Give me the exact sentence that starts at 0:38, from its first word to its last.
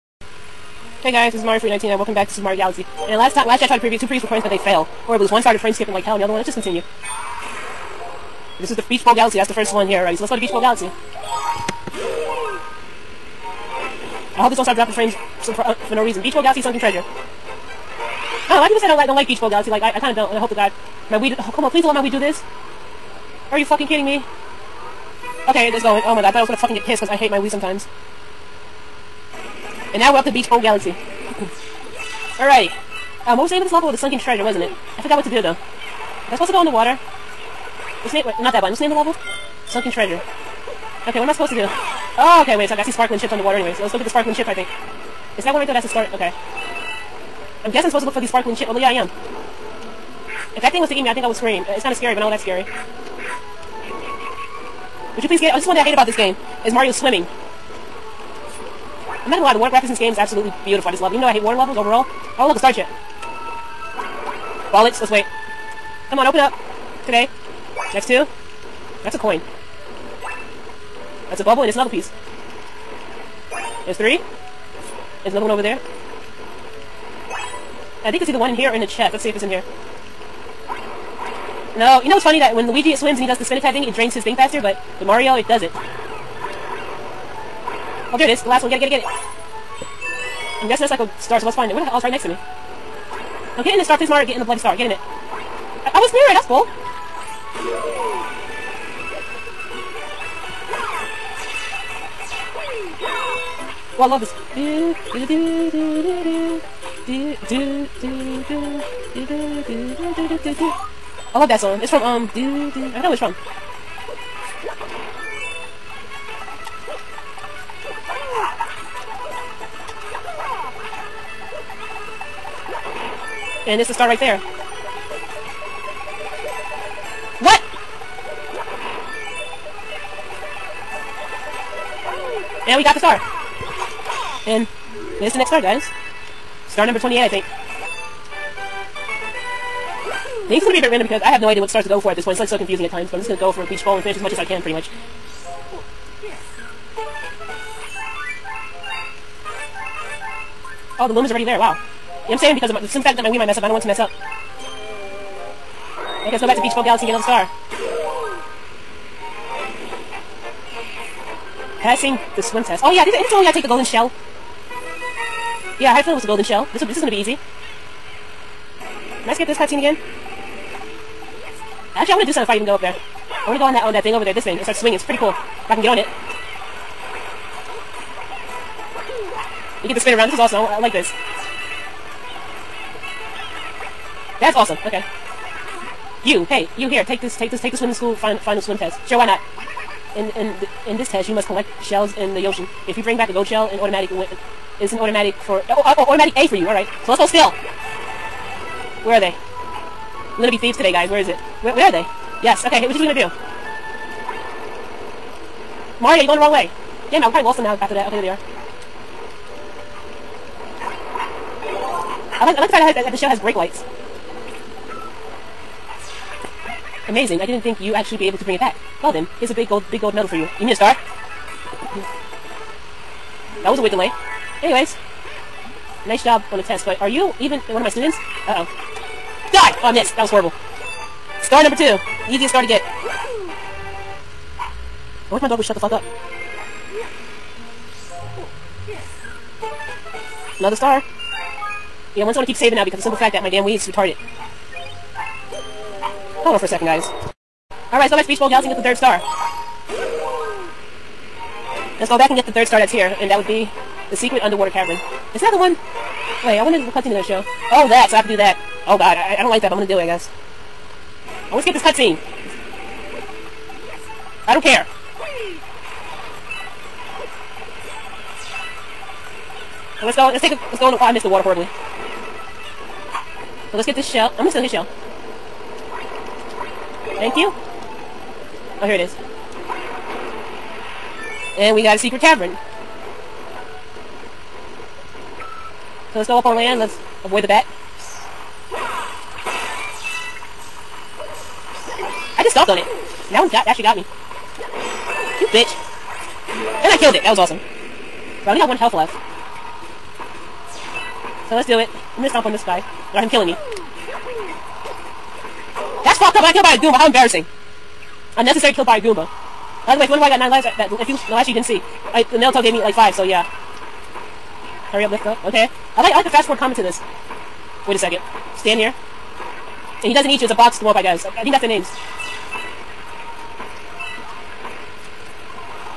What's the name of the level?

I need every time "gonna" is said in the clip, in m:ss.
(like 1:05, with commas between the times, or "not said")
0:26, 0:59, 2:46, 3:20, 4:02, 4:34, 5:02.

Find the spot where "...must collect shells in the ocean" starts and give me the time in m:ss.
3:11.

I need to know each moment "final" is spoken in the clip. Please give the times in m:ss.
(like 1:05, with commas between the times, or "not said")
3:08.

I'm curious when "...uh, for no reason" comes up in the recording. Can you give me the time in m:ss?
0:15.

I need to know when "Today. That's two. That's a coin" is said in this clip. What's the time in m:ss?
1:07.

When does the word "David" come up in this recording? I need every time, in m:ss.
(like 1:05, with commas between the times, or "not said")
not said.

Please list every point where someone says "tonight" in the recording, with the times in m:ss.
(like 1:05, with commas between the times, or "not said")
not said.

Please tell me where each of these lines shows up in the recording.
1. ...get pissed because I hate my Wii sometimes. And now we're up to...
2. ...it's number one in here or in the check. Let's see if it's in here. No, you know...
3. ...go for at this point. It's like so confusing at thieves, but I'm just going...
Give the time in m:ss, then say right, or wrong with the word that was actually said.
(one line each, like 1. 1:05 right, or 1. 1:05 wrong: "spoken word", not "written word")
1. 0:26 right
2. 1:18 wrong: "either", not "number"
3. 2:21 wrong: "times", not "thieves".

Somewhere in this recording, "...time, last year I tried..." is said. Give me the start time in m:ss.
0:03.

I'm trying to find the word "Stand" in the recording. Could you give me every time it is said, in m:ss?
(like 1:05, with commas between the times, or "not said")
5:18.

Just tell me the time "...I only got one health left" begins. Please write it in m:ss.
4:58.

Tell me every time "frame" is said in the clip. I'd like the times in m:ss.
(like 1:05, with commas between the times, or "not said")
0:05, 0:14.